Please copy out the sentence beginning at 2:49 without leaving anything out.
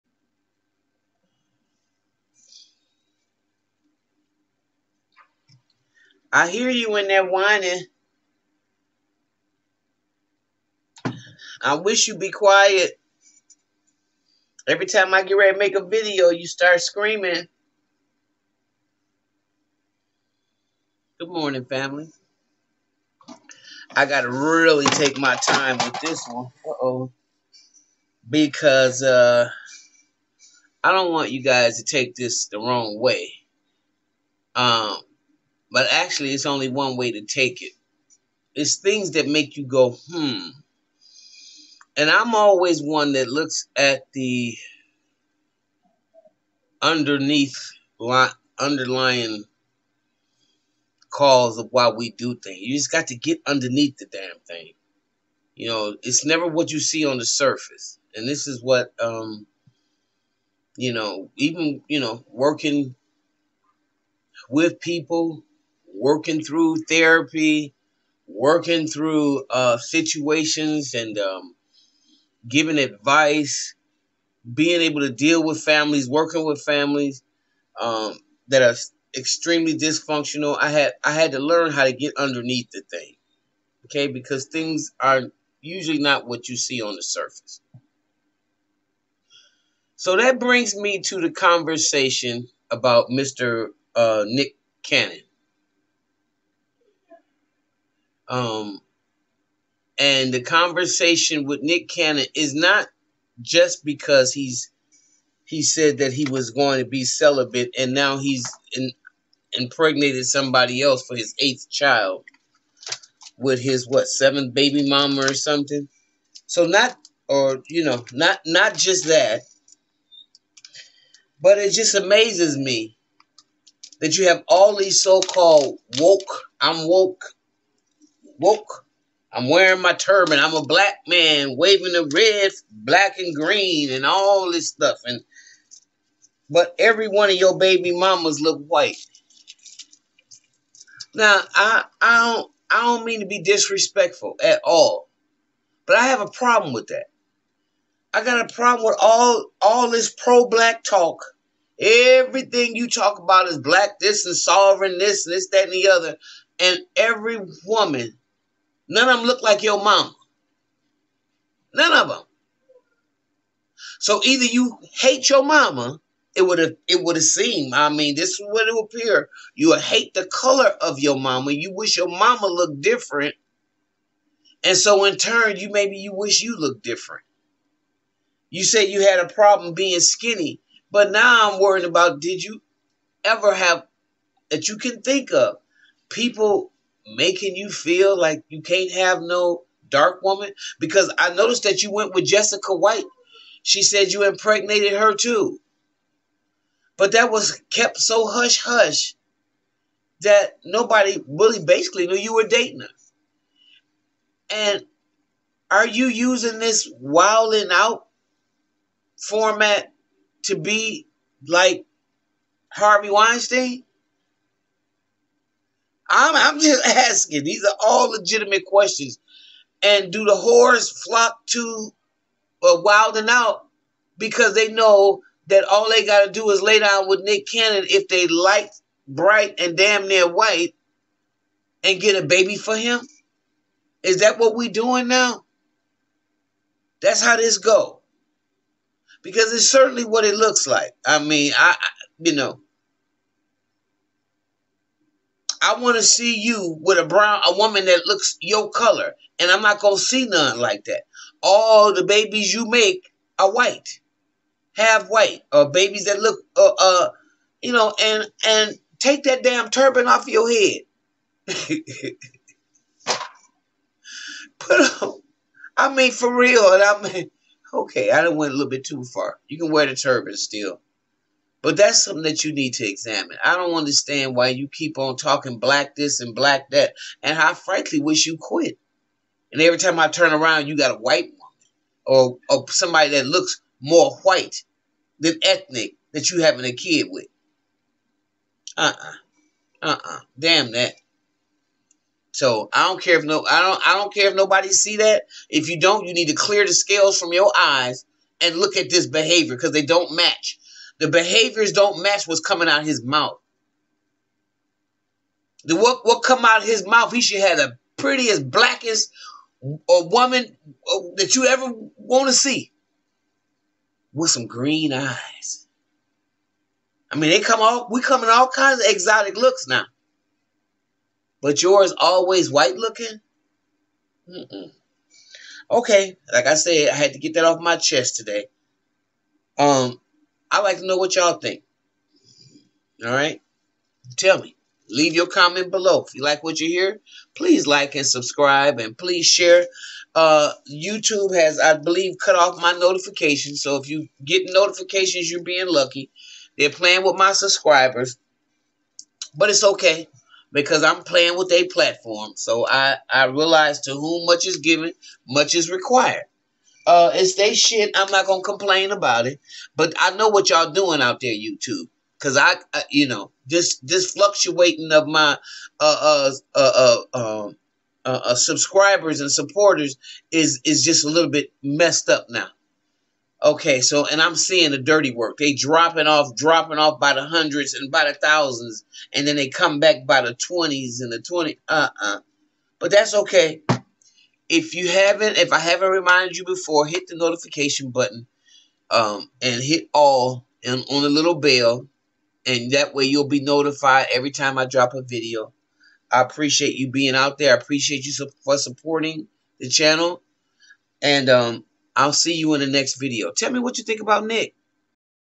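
You hate the color of your mama.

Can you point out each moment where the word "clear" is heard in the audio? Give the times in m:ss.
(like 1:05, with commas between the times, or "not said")
4:56.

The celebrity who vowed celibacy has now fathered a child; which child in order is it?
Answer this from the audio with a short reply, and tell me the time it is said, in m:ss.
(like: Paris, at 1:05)
eighth, at 1:51.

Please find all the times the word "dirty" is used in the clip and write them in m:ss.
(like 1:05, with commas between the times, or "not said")
6:14.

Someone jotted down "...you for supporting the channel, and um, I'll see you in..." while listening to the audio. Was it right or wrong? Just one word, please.
right.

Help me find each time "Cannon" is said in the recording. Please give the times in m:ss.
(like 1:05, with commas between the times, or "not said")
1:34, 1:41, 3:47.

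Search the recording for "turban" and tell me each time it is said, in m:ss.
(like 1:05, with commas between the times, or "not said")
2:09, 4:19, 4:29.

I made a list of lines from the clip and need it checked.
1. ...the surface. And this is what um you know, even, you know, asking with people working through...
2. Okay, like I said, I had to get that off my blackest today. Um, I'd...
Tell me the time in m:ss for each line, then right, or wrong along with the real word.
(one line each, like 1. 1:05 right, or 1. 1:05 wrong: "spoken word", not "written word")
1. 0:57 wrong: "working", not "asking"
2. 5:25 wrong: "chest", not "blackest".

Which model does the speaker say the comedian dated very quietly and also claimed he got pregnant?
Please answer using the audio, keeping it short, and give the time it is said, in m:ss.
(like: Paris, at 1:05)
Jessica White, at 3:12.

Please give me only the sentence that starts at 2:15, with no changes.
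And but every one of your baby mamas look white.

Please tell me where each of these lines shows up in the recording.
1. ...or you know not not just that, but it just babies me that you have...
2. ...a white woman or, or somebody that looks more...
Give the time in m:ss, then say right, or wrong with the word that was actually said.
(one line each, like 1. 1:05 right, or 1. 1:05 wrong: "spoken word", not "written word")
1. 1:57 wrong: "amazes", not "babies"
2. 4:40 right.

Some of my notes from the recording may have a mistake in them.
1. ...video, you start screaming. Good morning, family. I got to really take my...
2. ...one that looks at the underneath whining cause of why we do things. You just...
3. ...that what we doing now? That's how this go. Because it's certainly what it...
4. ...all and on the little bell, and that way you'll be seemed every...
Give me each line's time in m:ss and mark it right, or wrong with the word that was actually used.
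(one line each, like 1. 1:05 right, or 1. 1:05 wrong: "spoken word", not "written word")
1. 0:15 right
2. 0:42 wrong: "underlying", not "whining"
3. 3:54 right
4. 6:29 wrong: "notified", not "seemed".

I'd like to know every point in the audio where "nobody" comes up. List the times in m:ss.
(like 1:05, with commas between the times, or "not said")
3:20, 4:54.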